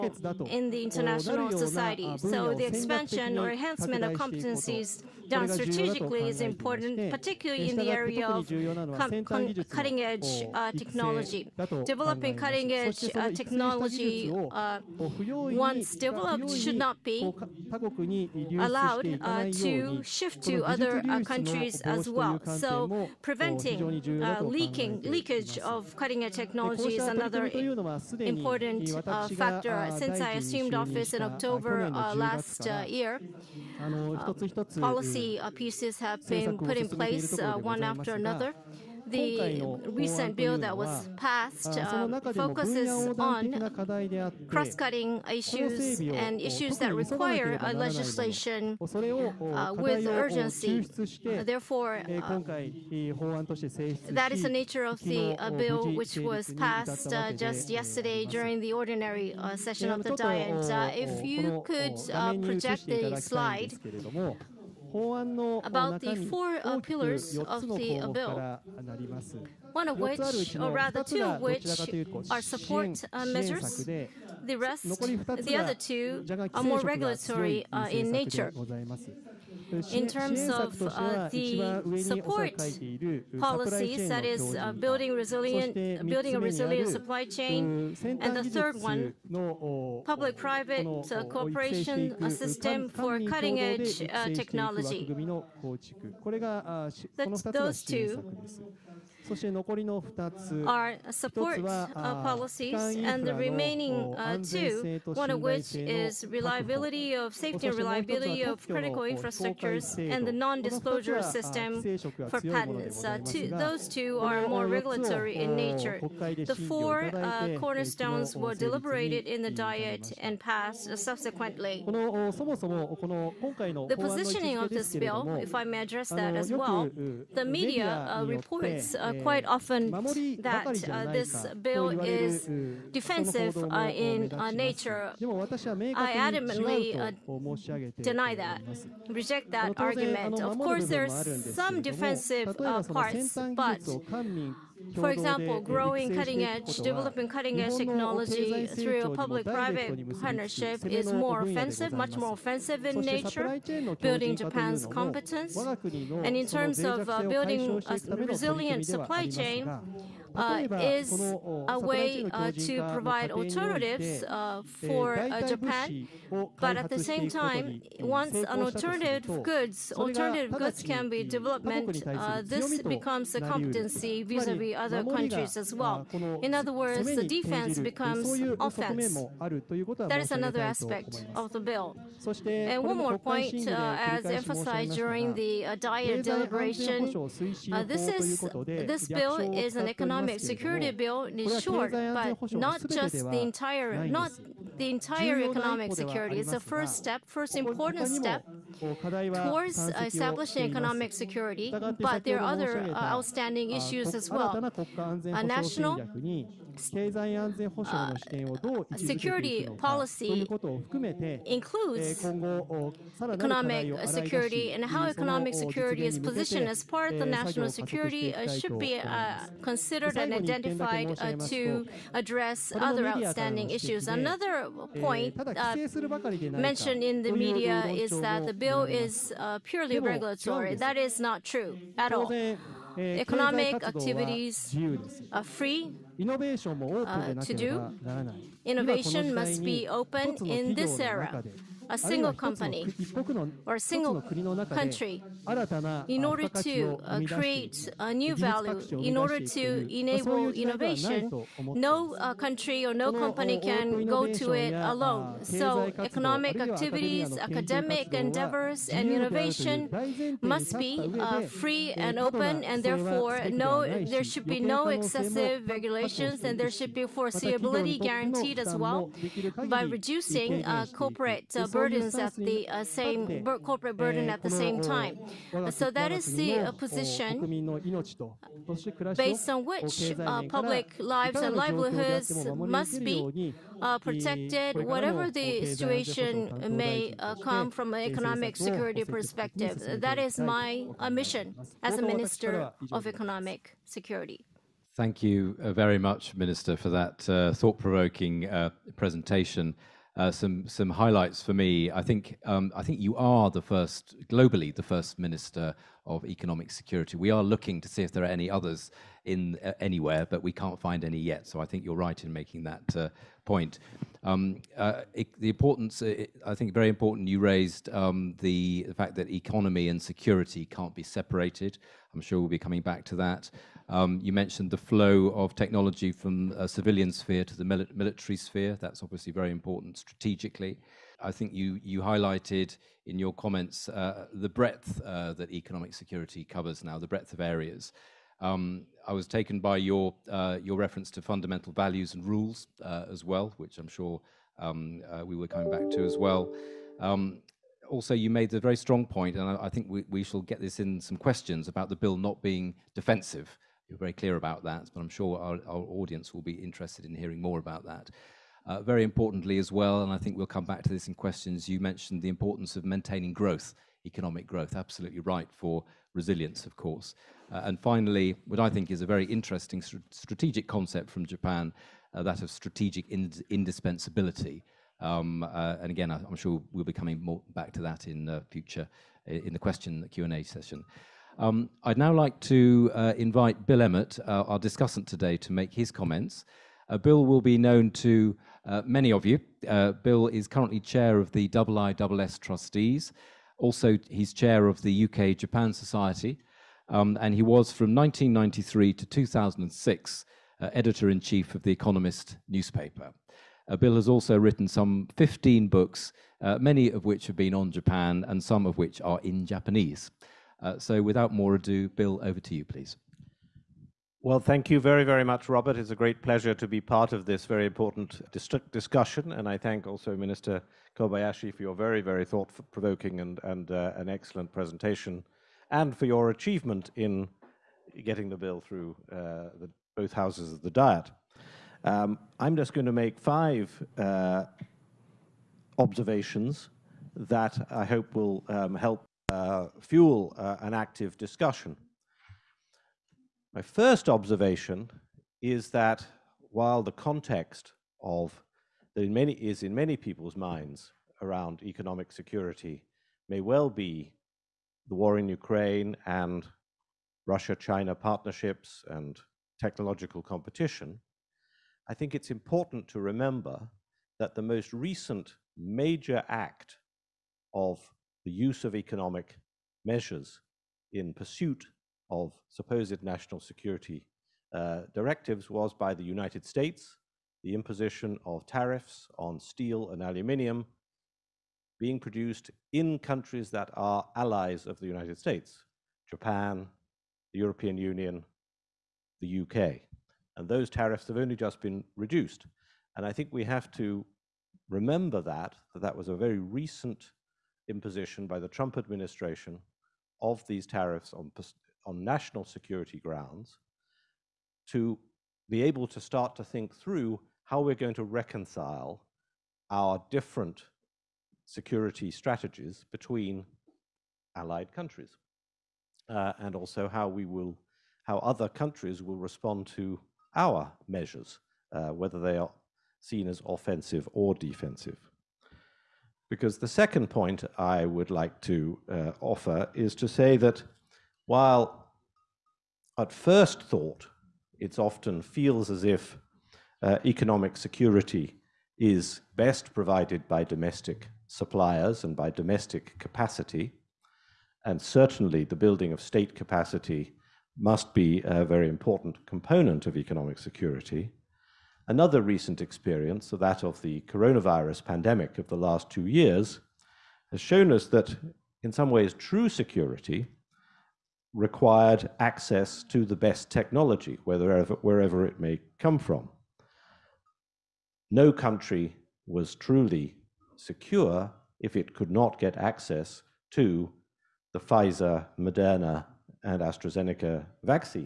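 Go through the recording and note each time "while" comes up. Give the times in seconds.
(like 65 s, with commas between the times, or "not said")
446 s, 531 s.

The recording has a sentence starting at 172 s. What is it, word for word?
this becomes a competency vis-à-vis other countries as well.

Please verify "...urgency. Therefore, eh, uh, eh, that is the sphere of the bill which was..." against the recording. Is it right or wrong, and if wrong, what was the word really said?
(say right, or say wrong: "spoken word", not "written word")
wrong: "nature", not "sphere".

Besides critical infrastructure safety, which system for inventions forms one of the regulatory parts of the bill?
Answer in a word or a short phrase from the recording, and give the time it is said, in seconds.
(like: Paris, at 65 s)
non-disclosure system for patents, at 110 s.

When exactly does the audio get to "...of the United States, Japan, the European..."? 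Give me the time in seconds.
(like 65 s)
484 s.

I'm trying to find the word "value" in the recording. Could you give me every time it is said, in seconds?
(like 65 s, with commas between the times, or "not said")
248 s, 341 s.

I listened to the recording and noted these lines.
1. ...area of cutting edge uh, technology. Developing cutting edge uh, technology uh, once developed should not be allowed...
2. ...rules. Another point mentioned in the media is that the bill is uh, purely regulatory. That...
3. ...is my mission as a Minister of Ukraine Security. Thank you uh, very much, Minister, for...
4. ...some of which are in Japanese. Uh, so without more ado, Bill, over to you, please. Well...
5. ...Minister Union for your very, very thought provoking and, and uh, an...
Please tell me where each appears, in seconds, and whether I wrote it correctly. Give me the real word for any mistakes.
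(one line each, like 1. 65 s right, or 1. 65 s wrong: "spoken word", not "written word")
1. 8 s right
2. 223 s wrong: "issues", not "rules"
3. 290 s wrong: "Economic", not "Ukraine"
4. 408 s right
5. 420 s wrong: "Kobayashi", not "Union".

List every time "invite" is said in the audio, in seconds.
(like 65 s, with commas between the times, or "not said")
383 s.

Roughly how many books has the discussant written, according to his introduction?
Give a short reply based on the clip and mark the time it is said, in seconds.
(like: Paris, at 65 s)
15, at 405 s.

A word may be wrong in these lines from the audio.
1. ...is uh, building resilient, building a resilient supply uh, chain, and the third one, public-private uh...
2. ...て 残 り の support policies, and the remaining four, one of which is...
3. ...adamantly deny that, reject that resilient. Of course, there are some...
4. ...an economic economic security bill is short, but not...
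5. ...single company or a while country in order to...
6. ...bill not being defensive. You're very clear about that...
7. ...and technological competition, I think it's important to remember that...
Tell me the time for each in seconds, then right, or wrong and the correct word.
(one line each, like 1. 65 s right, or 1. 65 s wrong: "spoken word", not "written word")
1. 84 s right
2. 99 s wrong: "two", not "four"
3. 136 s wrong: "argument", not "resilient"
4. 189 s right
5. 241 s wrong: "single", not "while"
6. 351 s right
7. 458 s right.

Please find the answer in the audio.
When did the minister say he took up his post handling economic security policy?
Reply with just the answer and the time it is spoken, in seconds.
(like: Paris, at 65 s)
October last year, at 31 s.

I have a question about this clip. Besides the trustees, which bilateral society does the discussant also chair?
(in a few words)
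UK Japan Society.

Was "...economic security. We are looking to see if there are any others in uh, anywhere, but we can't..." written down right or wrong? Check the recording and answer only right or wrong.
right.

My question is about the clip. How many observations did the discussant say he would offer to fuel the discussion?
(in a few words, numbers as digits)
5.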